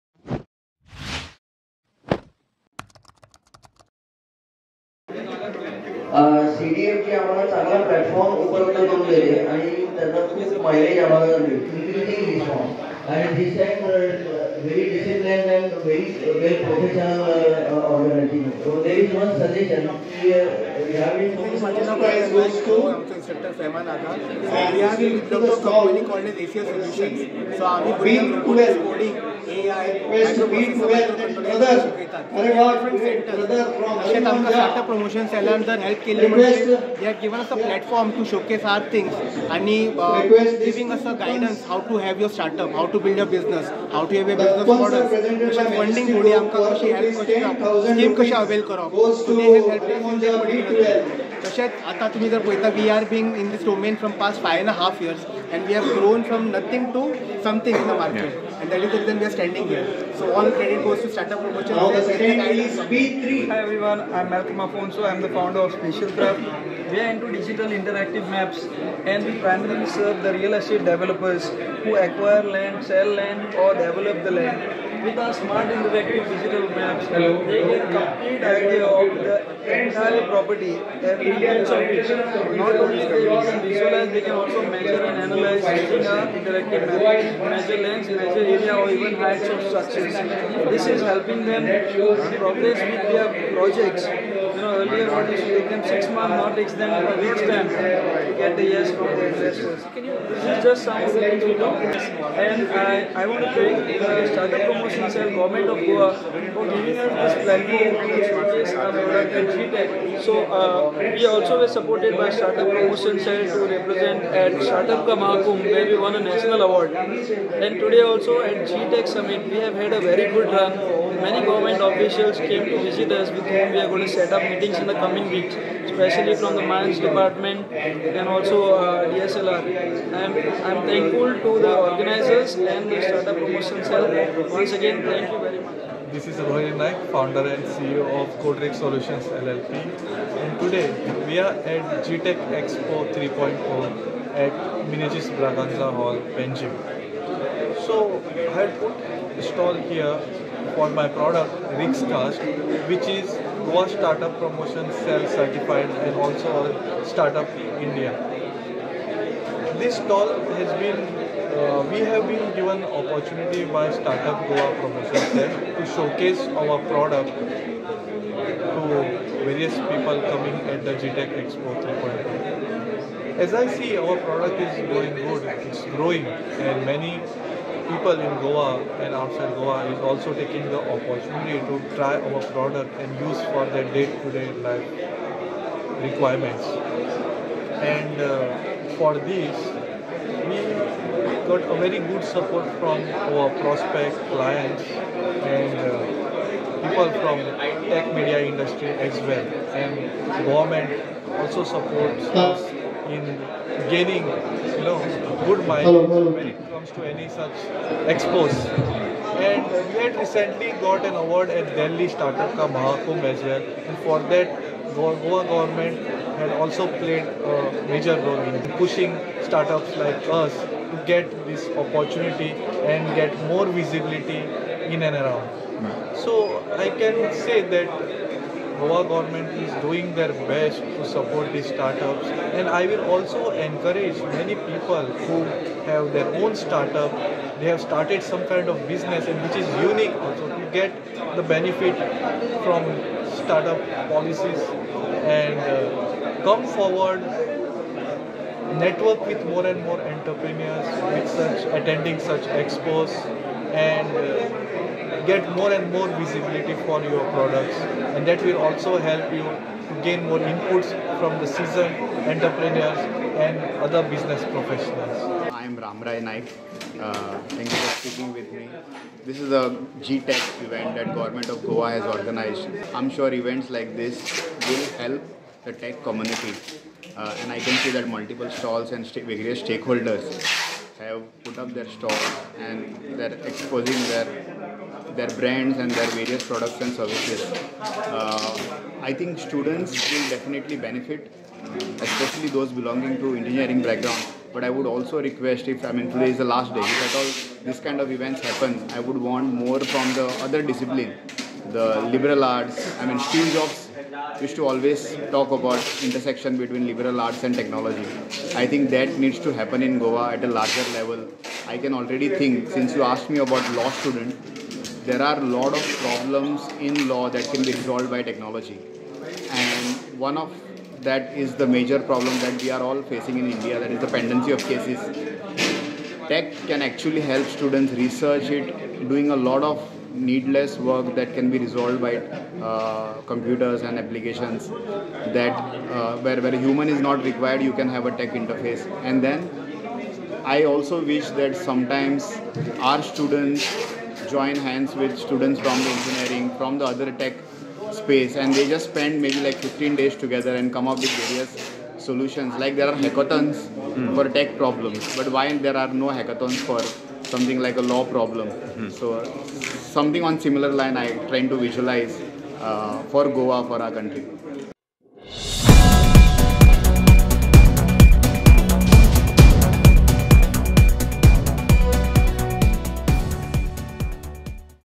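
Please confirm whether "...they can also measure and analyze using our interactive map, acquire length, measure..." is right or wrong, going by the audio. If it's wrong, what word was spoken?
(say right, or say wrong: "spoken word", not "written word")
wrong: "measure", not "acquire".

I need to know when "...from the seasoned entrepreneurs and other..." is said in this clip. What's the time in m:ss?
4:21.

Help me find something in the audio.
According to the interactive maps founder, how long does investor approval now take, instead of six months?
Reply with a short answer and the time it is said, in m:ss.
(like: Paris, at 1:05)
A week, at 1:37.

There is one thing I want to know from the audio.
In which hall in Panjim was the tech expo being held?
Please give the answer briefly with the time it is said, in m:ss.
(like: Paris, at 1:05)
Menezes Braganza Hall, at 2:24.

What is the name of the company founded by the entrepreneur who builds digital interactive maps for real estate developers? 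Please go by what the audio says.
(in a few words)
Spatial Craft.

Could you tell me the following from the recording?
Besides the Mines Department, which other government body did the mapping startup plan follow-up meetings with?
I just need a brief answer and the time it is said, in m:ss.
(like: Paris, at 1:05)
DSLR, at 2:09.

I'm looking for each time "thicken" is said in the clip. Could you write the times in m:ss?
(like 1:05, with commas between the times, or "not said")
not said.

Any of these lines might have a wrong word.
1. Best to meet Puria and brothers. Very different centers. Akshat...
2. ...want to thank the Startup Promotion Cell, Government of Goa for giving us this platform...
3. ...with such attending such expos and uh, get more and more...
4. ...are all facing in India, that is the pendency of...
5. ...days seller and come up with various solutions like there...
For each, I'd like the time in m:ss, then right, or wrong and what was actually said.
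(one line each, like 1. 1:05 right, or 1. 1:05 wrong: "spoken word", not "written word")
1. 0:30 right
2. 1:43 right
3. 4:11 right
4. 5:22 right
5. 5:49 wrong: "together", not "seller".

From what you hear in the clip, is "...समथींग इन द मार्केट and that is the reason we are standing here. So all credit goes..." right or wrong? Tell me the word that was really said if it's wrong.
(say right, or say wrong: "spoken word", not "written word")
right.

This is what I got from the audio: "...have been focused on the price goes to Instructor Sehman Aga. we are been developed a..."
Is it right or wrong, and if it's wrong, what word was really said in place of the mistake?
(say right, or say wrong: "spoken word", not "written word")
right.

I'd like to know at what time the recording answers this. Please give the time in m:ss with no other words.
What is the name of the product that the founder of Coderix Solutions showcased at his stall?
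2:31.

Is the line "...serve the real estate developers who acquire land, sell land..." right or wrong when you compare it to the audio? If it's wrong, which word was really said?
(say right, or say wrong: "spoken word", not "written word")
right.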